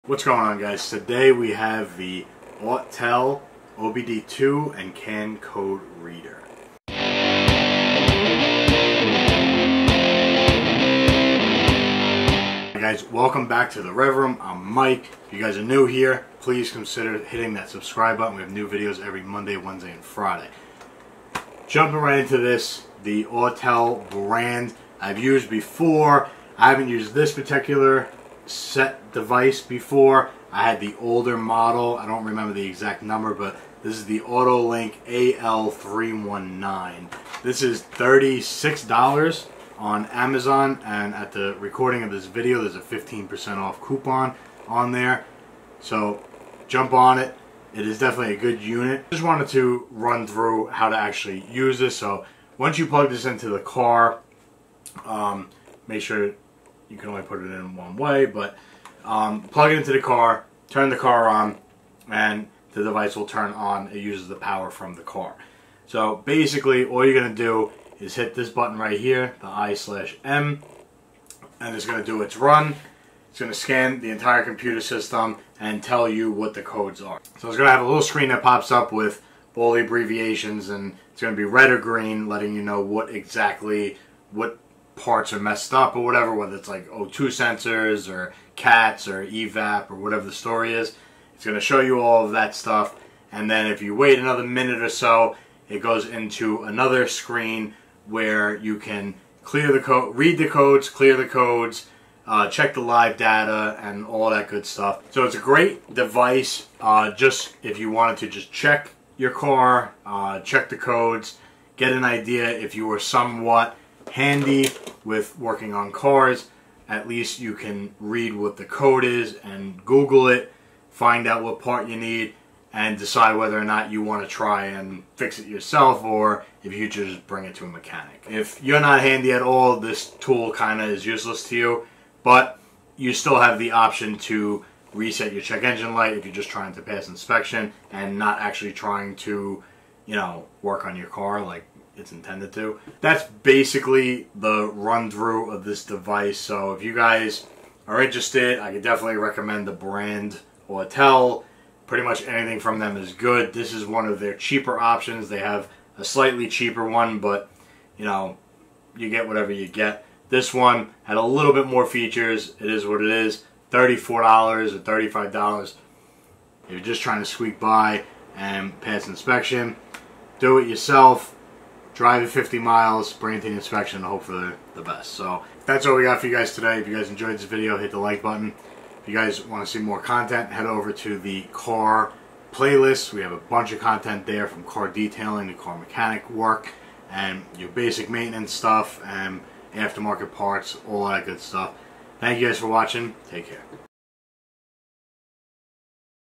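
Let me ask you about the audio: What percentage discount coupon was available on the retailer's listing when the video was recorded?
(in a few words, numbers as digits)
15%.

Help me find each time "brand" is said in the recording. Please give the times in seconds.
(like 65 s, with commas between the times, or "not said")
24 s, 149 s.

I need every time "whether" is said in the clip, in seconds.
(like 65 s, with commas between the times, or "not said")
86 s, 123 s.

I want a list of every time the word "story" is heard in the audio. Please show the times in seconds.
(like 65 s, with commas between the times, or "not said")
90 s.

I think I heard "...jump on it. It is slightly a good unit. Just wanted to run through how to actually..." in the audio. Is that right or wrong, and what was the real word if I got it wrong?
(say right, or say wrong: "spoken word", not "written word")
wrong: "definitely", not "slightly".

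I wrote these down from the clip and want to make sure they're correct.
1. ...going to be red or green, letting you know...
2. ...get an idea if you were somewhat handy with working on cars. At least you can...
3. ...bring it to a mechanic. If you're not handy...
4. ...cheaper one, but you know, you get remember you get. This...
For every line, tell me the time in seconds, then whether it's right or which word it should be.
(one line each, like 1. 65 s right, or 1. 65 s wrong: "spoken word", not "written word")
1. 81 s right
2. 111 s right
3. 127 s right
4. 156 s wrong: "whatever", not "remember".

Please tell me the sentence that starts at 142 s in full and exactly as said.
That's basically the run through of this device.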